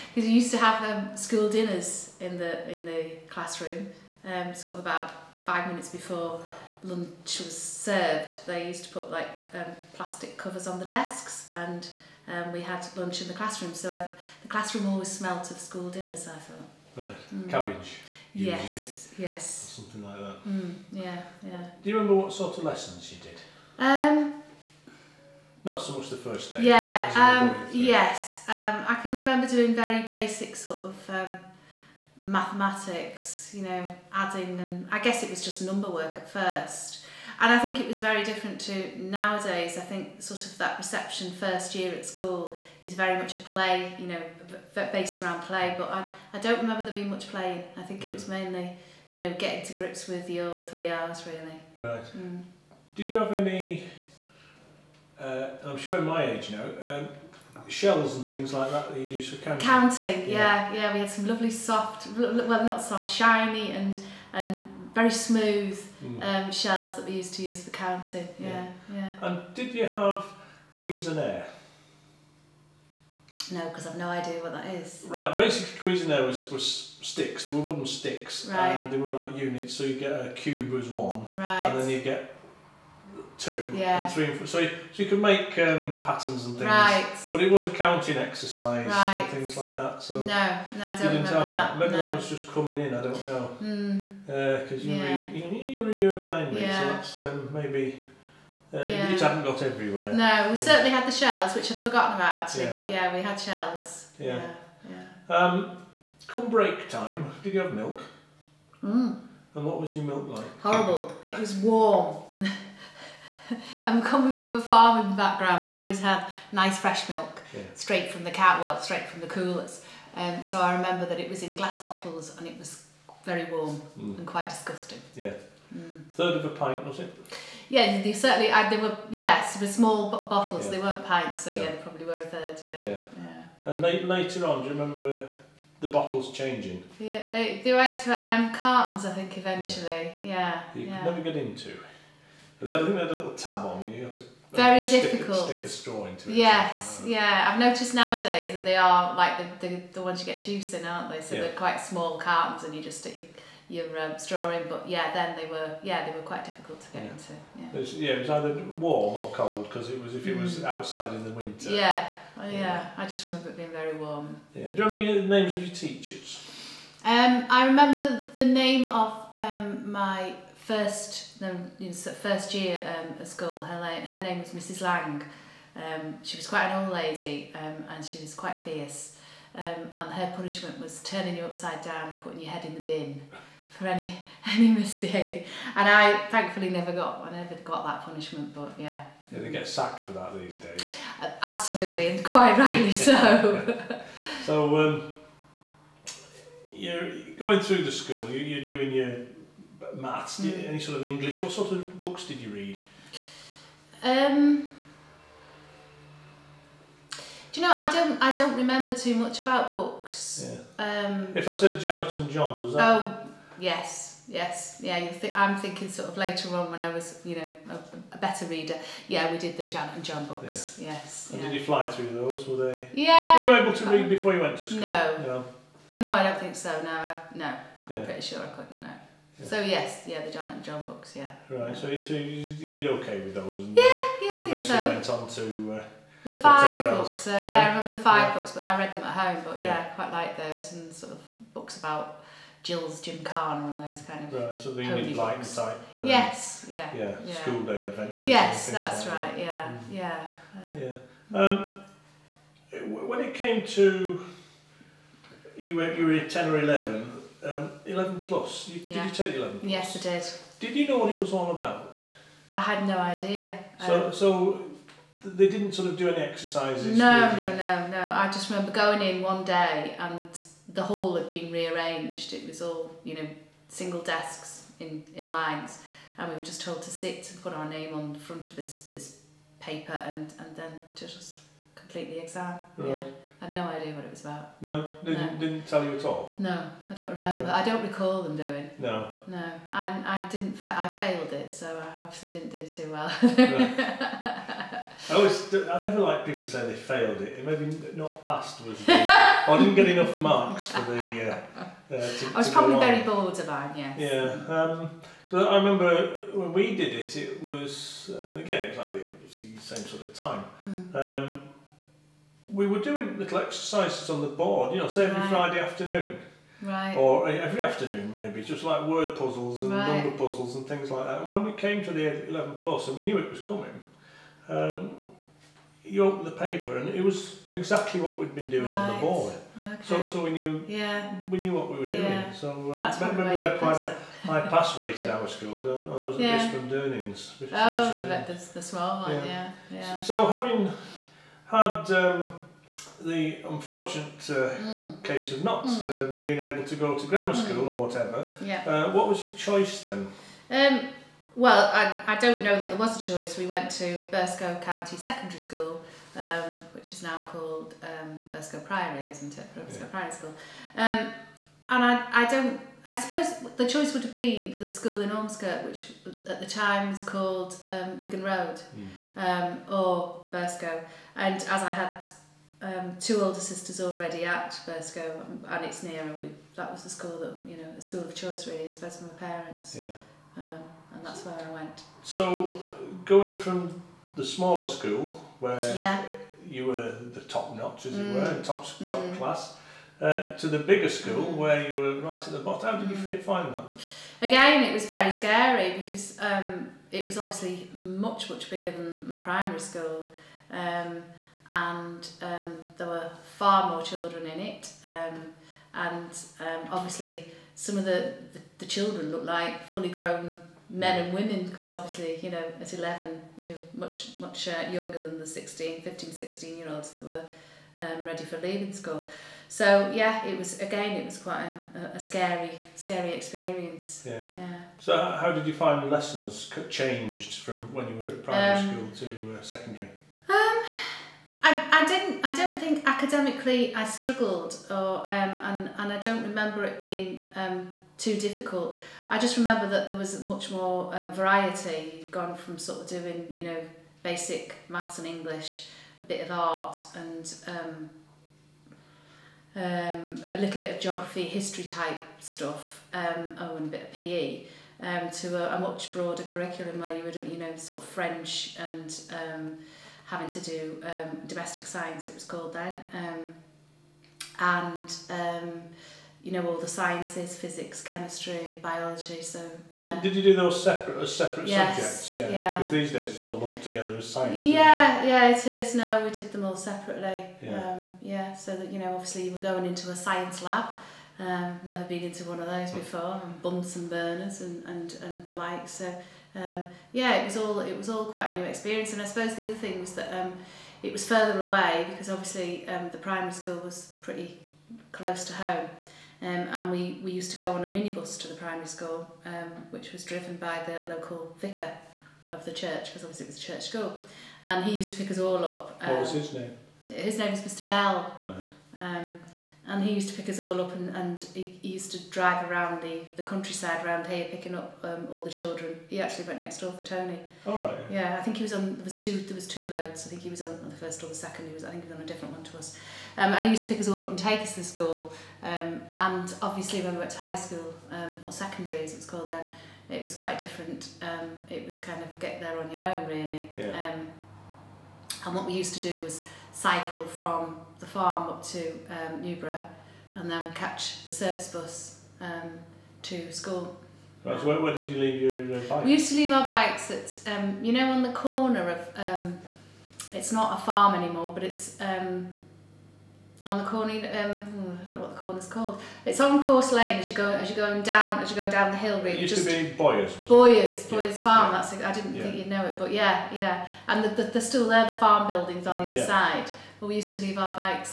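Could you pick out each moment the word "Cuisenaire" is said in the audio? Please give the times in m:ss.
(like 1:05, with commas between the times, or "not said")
1:10, 1:15.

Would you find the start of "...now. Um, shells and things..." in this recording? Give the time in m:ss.
0:56.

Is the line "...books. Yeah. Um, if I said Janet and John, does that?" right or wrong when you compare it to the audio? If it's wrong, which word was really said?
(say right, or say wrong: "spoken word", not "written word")
right.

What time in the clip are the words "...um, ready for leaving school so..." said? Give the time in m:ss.
6:57.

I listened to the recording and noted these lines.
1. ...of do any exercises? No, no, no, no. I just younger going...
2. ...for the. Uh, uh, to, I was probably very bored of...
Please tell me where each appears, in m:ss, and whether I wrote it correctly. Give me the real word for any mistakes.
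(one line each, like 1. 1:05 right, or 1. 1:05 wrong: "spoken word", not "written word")
1. 4:25 wrong: "remember", not "younger"
2. 5:00 right.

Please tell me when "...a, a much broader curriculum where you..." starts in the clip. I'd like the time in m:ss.
7:35.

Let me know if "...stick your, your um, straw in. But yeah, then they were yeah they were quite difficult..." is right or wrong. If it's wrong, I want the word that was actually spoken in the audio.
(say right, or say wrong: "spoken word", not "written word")
right.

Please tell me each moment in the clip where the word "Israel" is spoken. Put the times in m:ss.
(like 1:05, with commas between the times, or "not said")
not said.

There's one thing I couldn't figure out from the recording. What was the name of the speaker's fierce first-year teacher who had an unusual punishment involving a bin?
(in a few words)
Mrs. Lang.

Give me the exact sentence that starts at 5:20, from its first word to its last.
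number puzzles and things like that.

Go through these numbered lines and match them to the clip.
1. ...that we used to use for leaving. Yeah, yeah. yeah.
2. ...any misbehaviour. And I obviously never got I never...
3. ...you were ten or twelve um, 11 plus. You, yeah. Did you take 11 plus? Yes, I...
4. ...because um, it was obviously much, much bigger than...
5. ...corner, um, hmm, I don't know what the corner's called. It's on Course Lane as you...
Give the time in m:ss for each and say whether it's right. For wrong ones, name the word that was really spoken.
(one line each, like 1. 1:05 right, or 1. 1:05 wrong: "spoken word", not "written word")
1. 1:06 wrong: "counting", not "leaving"
2. 3:04 wrong: "thankfully", not "obviously"
3. 4:15 wrong: "eleven", not "twelve"
4. 6:35 right
5. 9:13 right.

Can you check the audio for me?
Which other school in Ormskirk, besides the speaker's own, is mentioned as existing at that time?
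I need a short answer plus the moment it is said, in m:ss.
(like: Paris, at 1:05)
Wigan Road, at 6:07.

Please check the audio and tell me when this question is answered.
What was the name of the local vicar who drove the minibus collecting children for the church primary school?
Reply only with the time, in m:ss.
8:27.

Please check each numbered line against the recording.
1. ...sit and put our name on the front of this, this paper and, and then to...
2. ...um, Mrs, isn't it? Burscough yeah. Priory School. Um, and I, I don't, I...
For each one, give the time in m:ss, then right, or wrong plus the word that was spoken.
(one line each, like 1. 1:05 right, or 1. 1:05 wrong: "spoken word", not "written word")
1. 4:36 right
2. 5:57 wrong: "Priory", not "Mrs".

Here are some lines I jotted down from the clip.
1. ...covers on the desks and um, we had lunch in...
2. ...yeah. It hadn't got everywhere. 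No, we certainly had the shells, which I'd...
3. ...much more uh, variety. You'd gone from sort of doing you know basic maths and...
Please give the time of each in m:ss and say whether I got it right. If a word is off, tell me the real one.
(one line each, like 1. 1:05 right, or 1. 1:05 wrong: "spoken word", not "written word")
1. 0:10 right
2. 1:38 right
3. 7:20 right.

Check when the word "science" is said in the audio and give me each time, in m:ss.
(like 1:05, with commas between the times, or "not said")
7:41, 7:46, 7:54, 7:59.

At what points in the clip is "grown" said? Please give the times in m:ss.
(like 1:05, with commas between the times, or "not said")
6:49.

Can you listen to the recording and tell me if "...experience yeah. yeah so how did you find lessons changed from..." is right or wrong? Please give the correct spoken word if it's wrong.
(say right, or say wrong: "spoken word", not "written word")
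right.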